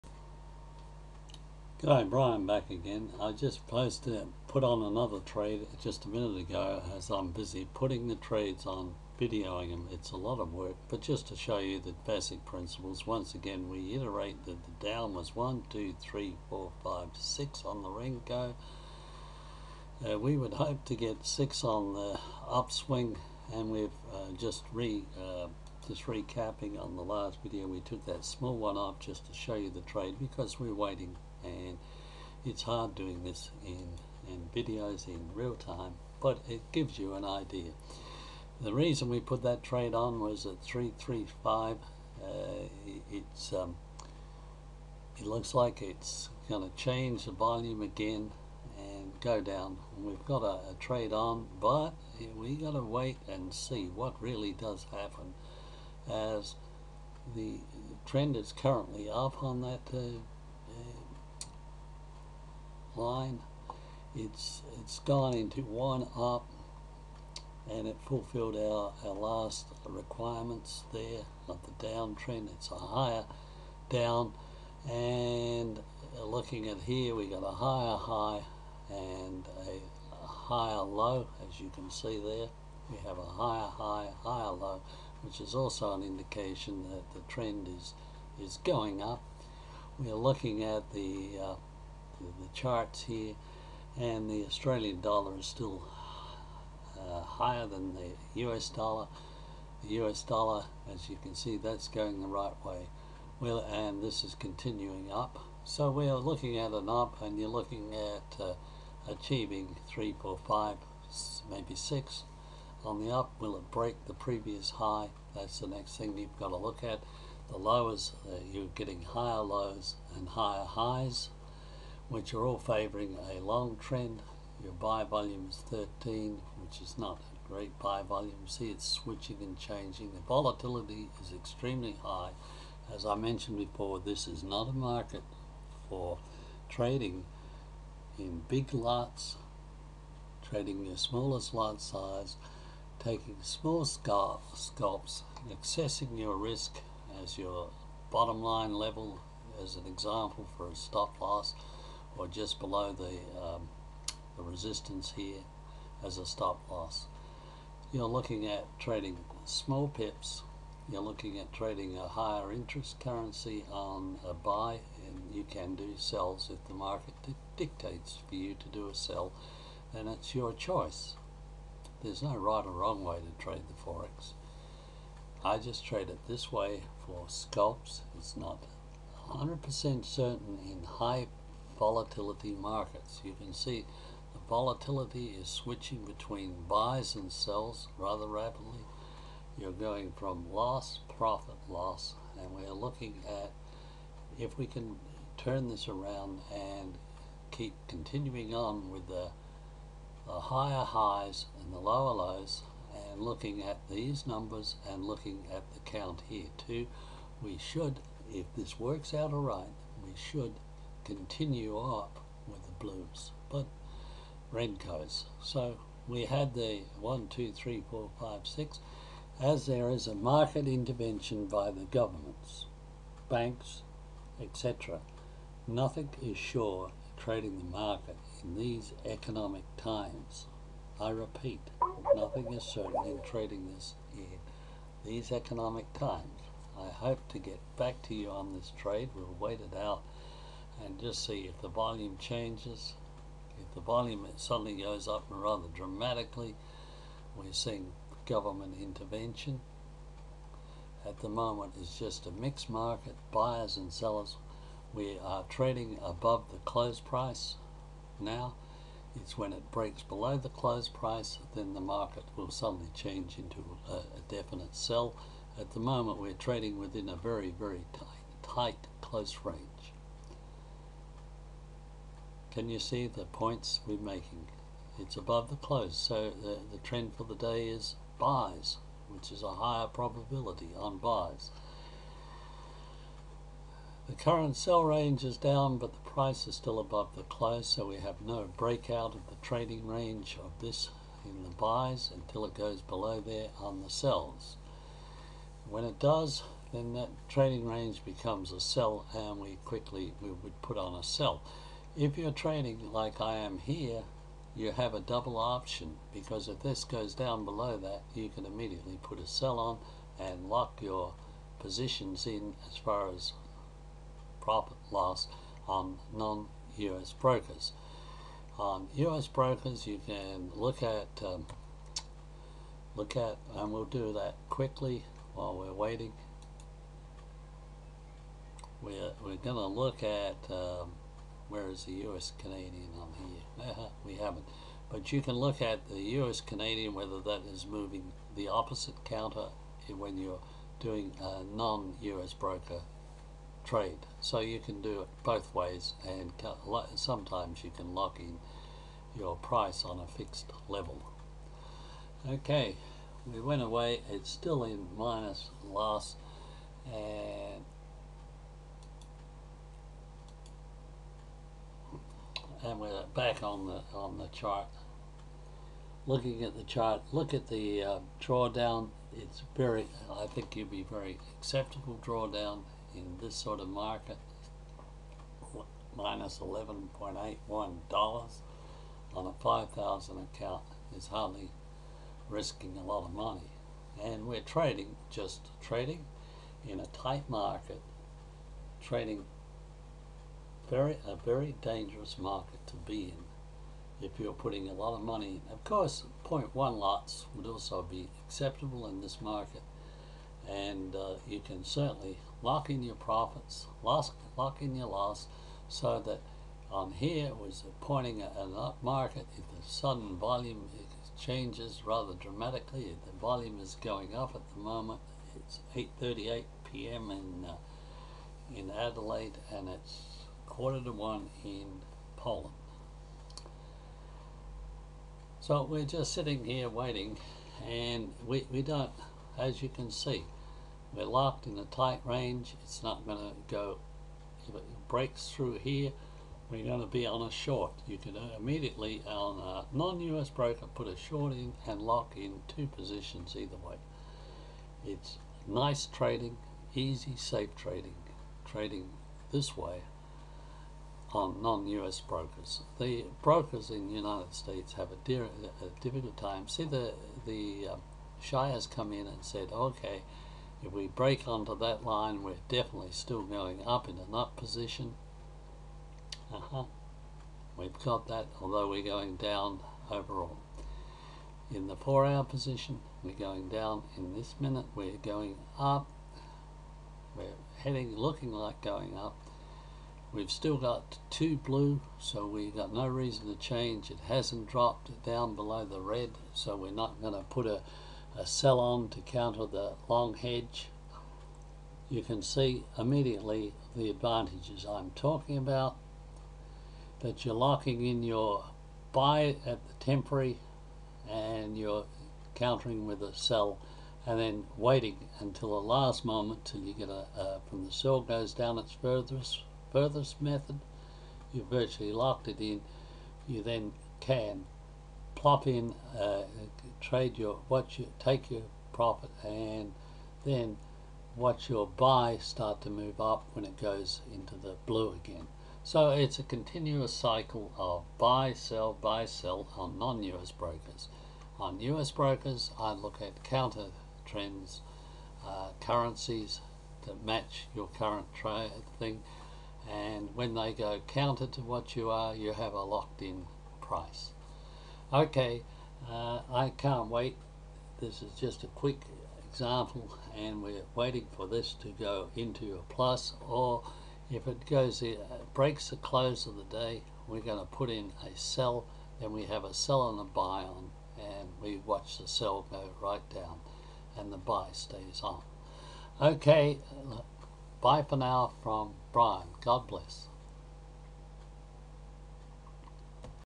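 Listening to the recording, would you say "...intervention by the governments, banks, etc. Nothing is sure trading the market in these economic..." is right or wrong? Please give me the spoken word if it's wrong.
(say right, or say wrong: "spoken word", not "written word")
right.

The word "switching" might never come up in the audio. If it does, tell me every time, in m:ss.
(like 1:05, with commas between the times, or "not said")
2:08, 3:05.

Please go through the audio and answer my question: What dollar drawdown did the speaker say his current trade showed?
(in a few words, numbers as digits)
$11.81.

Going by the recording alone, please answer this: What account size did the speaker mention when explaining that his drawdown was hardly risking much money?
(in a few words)
5,000.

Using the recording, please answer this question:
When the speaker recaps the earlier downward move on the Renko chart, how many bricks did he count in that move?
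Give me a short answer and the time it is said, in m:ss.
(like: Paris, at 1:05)
6, at 0:17.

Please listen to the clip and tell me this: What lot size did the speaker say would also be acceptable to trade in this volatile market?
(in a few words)
0.1 lots.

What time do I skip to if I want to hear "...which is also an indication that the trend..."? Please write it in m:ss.
1:25.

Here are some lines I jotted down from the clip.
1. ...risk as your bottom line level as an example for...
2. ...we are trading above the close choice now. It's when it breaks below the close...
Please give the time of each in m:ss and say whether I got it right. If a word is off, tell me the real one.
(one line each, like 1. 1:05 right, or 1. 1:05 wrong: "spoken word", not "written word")
1. 2:26 right
2. 4:14 wrong: "price", not "choice".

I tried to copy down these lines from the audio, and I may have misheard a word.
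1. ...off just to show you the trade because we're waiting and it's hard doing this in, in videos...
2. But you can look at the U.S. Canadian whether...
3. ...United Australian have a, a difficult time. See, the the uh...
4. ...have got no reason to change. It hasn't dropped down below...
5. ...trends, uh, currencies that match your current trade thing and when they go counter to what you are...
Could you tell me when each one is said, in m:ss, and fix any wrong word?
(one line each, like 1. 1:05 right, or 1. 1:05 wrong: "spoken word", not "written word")
1. 0:28 right
2. 5:34 right
3. 7:33 wrong: "States", not "Australian"
4. 8:02 right
5. 8:54 right.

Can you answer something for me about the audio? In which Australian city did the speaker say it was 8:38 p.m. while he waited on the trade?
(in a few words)
Adelaide.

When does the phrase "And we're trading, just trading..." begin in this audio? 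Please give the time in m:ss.
6:24.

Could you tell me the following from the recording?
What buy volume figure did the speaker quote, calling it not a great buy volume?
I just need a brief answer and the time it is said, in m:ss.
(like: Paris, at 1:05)
13, at 2:05.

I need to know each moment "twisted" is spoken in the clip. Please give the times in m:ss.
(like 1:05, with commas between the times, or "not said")
not said.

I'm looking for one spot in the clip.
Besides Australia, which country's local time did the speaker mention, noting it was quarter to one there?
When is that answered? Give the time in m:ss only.
7:02.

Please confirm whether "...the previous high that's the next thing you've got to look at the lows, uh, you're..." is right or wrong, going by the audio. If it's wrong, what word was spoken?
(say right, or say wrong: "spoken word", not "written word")
right.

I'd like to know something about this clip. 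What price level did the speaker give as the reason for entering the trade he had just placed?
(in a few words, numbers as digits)
335.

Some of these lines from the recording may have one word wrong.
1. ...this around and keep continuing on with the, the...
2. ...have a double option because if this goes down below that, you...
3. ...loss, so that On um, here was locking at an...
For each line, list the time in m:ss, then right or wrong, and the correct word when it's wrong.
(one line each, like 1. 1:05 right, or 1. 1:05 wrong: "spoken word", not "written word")
1. 3:15 right
2. 5:04 right
3. 6:44 wrong: "pointing", not "locking".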